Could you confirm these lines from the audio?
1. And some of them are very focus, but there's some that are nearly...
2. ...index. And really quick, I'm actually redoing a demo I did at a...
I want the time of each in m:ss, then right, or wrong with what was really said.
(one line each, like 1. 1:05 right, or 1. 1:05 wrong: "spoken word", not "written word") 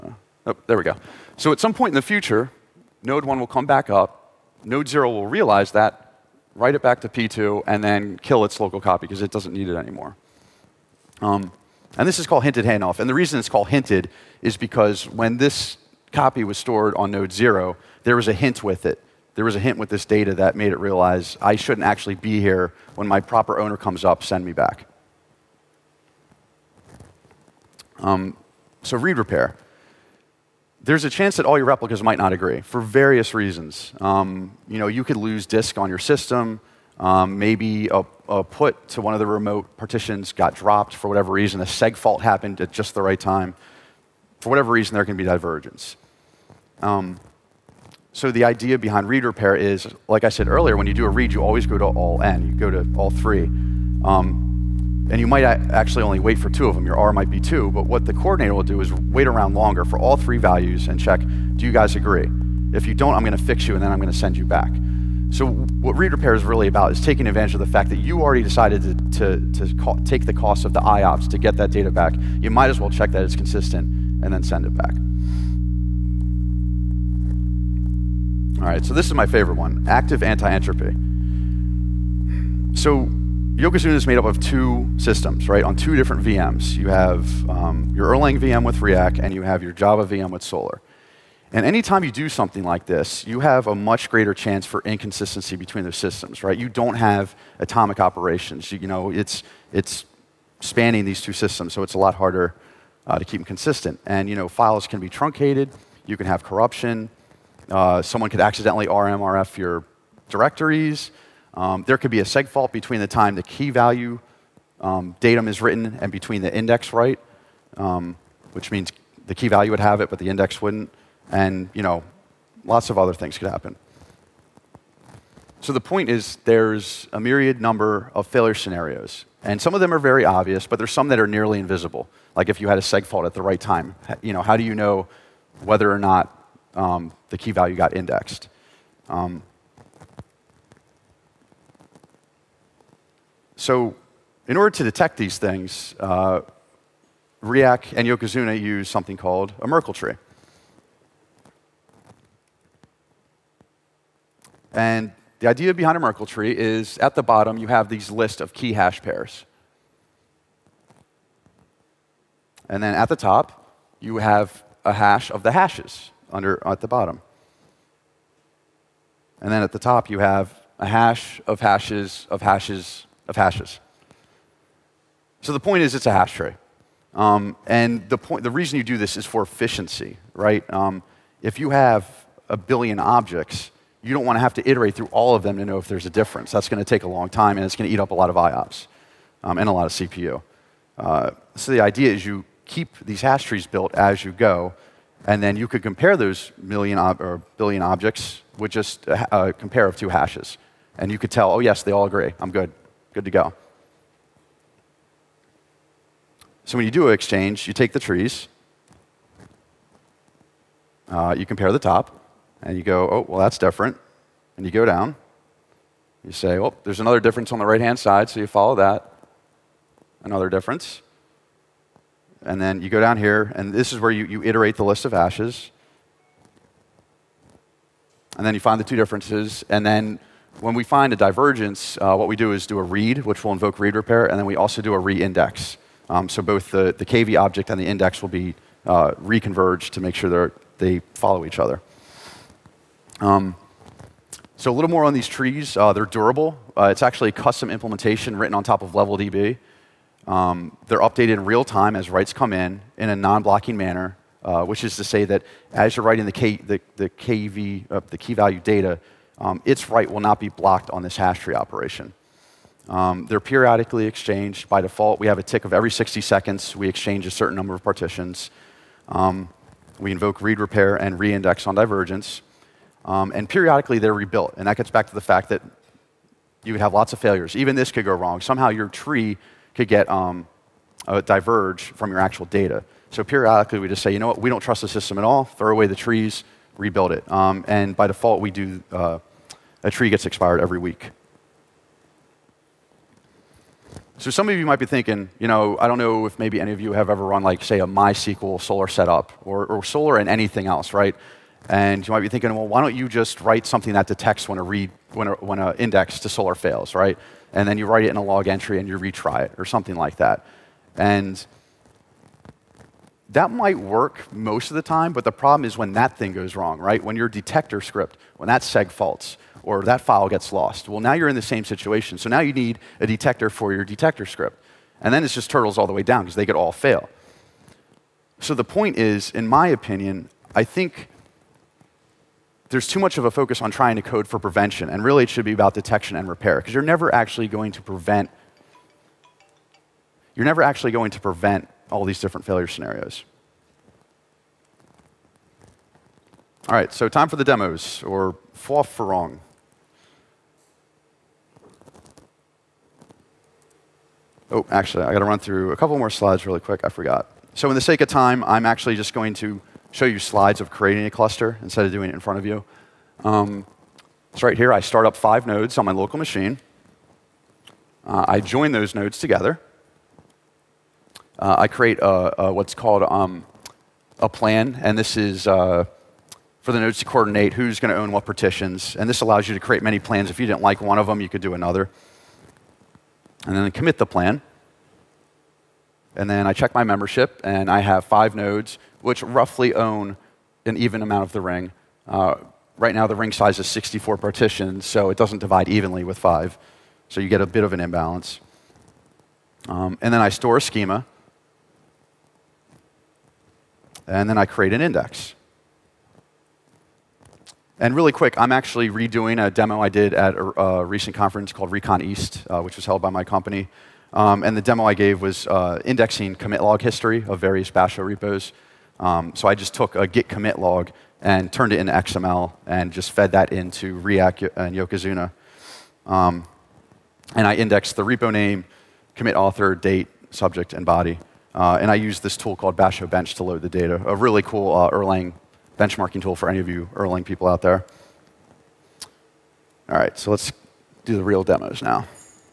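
1. 2:09 wrong: "obvious", not "focus"
2. 6:44 right.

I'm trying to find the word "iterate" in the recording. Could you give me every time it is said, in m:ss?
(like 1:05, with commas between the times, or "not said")
3:04, 3:44.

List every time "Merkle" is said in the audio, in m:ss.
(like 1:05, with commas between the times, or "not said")
2:29, 2:35.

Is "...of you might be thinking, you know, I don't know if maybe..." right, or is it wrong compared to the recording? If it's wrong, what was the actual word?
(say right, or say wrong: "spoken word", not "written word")
right.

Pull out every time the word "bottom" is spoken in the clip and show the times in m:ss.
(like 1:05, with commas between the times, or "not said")
2:37, 2:46.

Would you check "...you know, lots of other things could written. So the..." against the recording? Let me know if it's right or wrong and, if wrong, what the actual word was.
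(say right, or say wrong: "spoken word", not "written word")
wrong: "happen", not "written".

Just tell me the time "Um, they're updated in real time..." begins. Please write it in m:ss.
4:10.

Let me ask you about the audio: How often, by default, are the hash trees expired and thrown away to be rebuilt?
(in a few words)
every week.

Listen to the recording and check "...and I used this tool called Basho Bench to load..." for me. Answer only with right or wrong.
right.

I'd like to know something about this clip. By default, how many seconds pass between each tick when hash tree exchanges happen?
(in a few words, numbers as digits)
60.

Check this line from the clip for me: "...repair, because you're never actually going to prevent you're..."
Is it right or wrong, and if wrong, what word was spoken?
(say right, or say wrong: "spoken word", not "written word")
right.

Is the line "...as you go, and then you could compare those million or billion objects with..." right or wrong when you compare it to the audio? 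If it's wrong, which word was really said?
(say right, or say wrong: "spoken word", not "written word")
right.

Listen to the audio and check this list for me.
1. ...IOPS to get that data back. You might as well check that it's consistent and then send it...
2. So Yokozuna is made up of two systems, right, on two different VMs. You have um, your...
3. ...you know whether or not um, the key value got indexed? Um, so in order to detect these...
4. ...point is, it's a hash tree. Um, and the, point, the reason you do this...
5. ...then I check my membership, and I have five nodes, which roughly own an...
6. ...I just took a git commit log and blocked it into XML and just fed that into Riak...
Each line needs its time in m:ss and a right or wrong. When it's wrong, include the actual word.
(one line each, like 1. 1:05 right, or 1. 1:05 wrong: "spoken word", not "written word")
1. 1:10 right
2. 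1:22 right
3. 2:14 right
4. 2:55 right
5. 6:26 right
6. 6:59 wrong: "turned", not "blocked".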